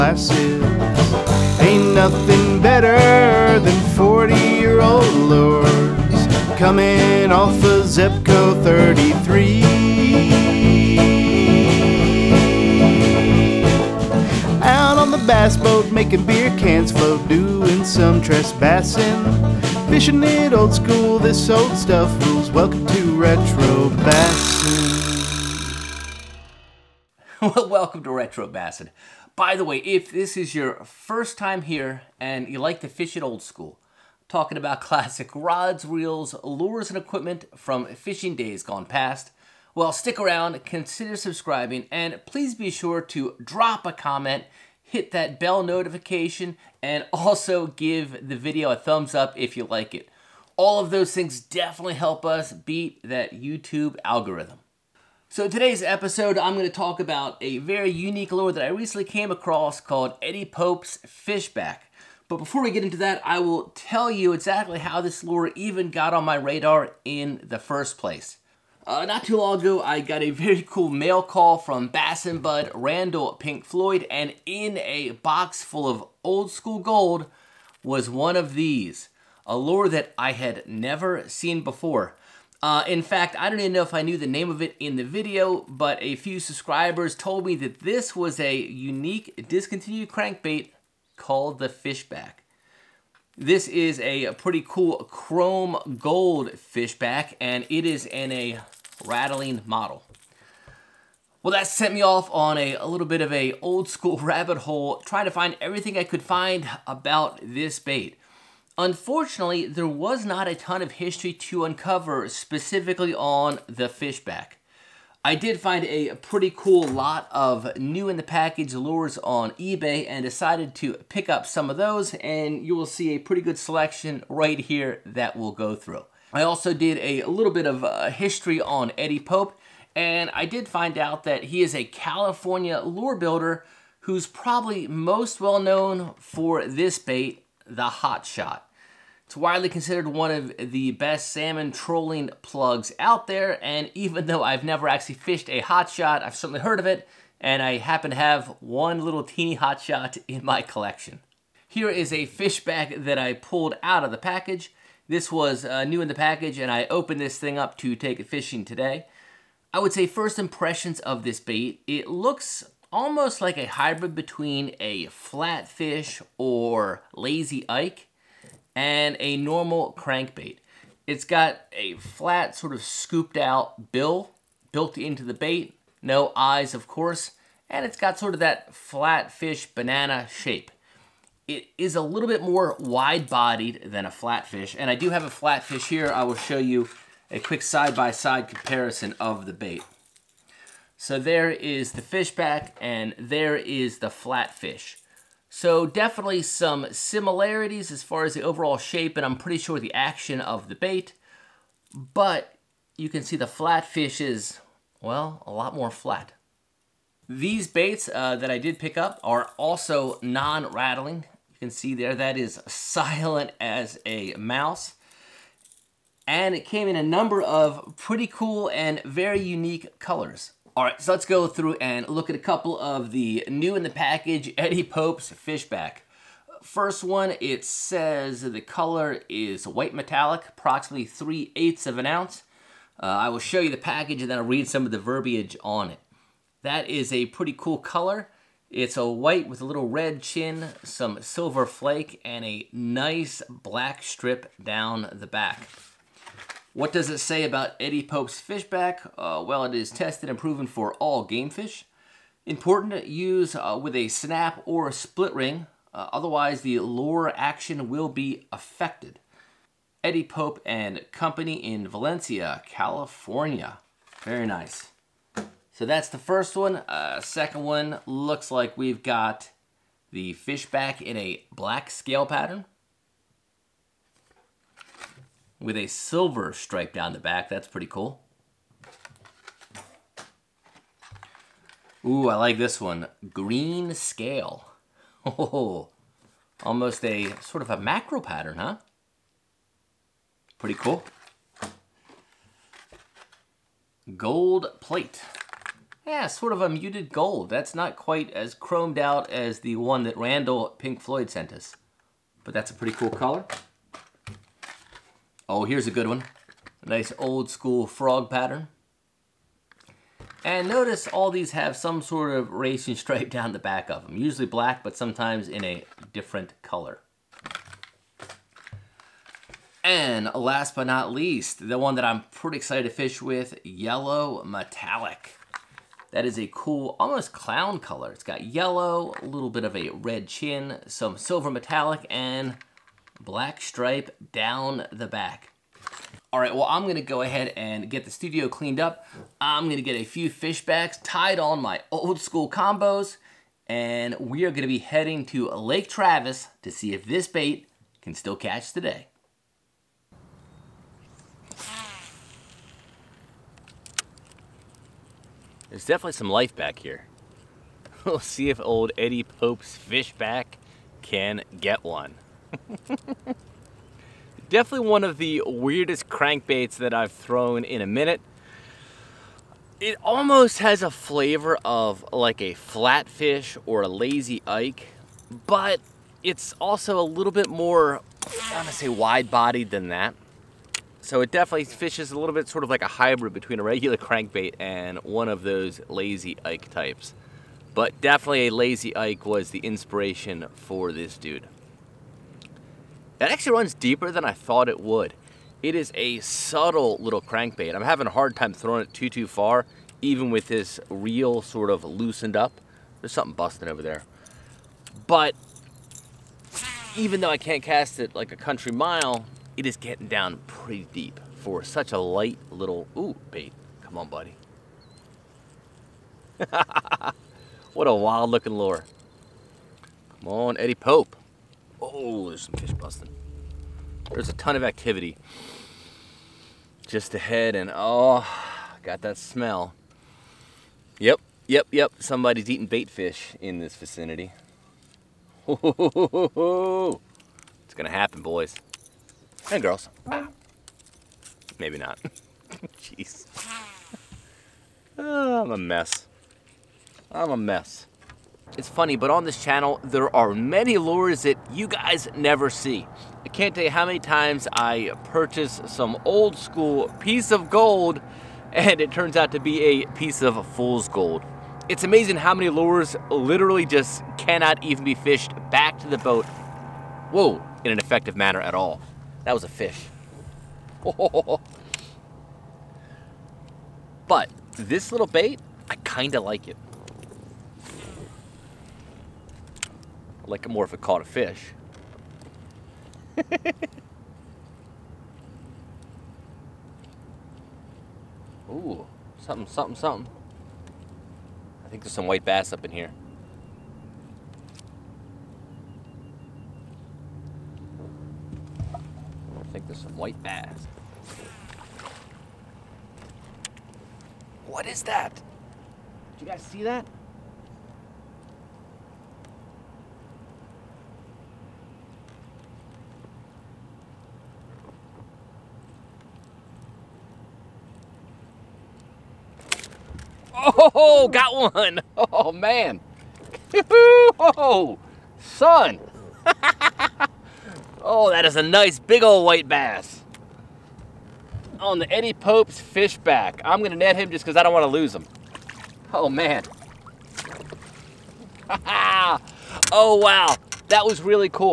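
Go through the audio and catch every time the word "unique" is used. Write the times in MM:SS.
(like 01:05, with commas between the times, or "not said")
00:57, 01:28, 03:39.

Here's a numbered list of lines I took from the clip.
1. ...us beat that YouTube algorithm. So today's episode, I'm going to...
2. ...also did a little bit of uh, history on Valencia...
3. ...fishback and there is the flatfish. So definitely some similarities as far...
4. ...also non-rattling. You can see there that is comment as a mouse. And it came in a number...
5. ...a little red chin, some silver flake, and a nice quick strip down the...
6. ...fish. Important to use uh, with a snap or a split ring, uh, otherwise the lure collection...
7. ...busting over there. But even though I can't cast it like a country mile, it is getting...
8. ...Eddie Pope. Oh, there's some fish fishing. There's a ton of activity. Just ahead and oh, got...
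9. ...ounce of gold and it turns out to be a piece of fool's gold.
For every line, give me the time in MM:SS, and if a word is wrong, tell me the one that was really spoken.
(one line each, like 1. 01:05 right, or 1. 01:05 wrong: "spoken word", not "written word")
1. 00:52 right
2. 02:06 wrong: "Eddie", not "Valencia"
3. 03:12 right
4. 03:29 wrong: "silent", not "comment"
5. 03:59 wrong: "black", not "quick"
6. 04:11 wrong: "action", not "collection"
7. 06:43 right
8. 07:00 wrong: "busting", not "fishing"
9. 07:37 wrong: "piece", not "ounce".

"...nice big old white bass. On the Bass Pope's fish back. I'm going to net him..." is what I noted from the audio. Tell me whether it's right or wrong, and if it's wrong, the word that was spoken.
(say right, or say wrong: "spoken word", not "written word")
wrong: "Eddie", not "Bass".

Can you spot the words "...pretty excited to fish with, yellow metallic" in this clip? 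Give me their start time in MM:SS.
05:22.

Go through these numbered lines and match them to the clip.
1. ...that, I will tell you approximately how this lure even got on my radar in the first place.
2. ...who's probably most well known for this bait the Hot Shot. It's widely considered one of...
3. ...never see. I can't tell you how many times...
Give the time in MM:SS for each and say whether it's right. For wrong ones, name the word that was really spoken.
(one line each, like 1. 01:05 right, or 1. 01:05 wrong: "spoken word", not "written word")
1. 01:02 wrong: "exactly", not "approximately"
2. 02:14 right
3. 07:32 right.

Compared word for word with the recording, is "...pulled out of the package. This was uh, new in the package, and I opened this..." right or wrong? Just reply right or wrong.
right.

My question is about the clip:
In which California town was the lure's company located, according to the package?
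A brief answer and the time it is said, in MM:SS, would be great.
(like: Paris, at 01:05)
Valencia, at 04:21.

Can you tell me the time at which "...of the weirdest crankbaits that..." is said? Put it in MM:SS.
06:05.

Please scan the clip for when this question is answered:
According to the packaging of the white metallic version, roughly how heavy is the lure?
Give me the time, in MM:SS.
03:51.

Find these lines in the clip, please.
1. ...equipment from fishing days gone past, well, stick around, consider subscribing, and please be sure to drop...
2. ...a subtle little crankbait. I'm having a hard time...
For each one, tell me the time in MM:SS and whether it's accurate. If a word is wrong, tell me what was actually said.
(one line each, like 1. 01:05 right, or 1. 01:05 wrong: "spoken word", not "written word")
1. 00:36 right
2. 06:35 right.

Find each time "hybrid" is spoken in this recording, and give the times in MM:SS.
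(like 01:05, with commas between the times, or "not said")
02:43, 06:22.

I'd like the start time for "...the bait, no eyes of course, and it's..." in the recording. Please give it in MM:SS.
02:55.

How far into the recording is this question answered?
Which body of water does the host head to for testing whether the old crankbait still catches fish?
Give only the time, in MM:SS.
05:45.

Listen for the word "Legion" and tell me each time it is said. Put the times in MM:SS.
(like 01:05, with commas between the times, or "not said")
not said.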